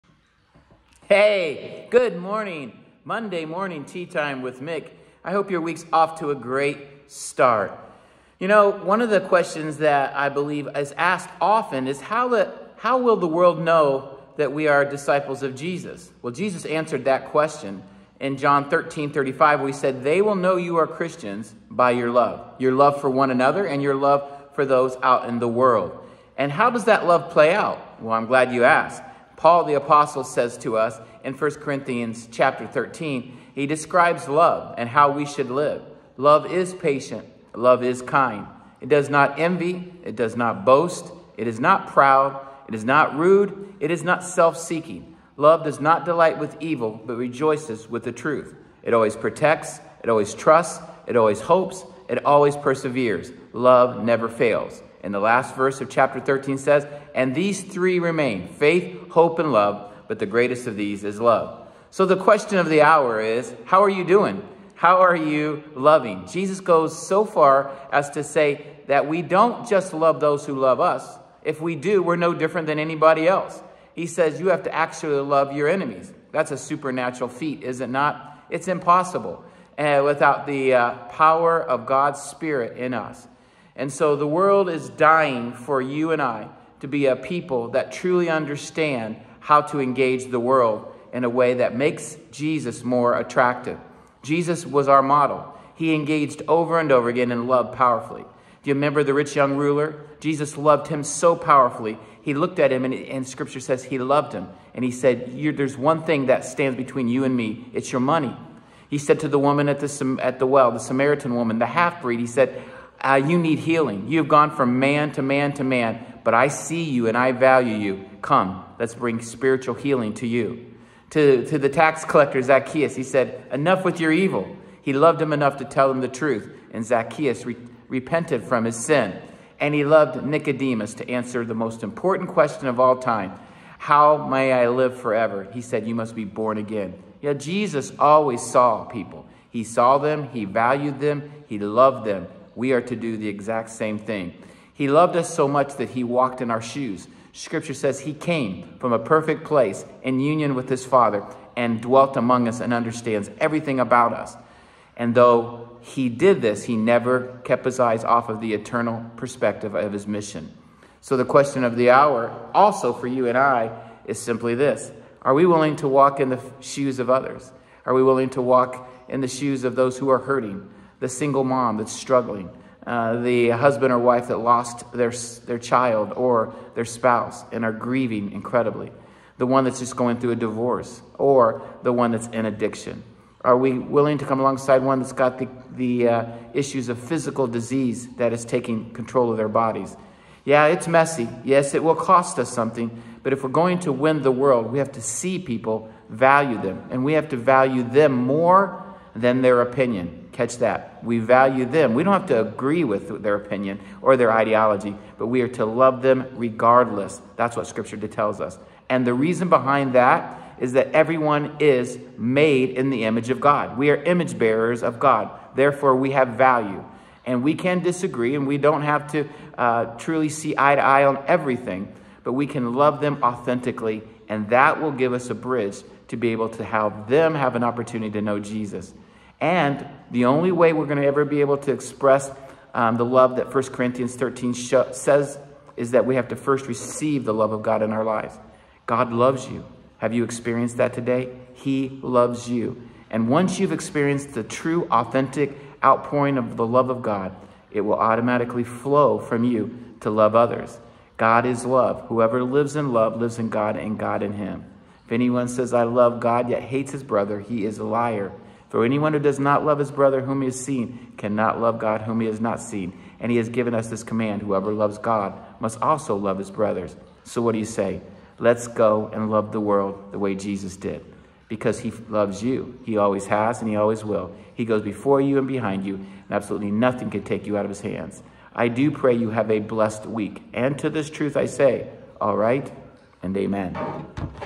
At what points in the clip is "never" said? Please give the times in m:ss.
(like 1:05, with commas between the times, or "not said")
0:54, 2:36.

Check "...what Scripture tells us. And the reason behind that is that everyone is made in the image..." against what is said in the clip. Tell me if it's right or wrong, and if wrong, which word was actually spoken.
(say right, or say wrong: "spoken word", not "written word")
right.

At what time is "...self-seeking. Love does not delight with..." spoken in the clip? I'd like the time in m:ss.
0:44.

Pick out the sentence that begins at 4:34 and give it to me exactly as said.
He goes before you and behind you, and absolutely nothing can take you out of his hands.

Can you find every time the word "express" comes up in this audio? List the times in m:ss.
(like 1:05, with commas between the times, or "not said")
3:51.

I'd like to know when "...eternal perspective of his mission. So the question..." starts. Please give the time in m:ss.
2:38.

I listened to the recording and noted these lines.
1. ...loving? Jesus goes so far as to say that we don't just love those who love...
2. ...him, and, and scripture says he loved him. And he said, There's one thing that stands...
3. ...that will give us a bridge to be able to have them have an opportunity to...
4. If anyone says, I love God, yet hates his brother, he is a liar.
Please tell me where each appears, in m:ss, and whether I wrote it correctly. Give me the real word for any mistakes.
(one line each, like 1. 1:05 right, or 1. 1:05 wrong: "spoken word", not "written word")
1. 1:05 right
2. 1:42 right
3. 3:44 right
4. 4:15 right.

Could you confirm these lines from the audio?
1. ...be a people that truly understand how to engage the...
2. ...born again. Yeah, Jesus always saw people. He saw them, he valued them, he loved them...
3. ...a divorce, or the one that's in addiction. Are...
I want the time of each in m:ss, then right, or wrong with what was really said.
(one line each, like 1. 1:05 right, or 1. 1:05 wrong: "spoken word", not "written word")
1. 1:26 right
2. 2:16 right
3. 3:00 right.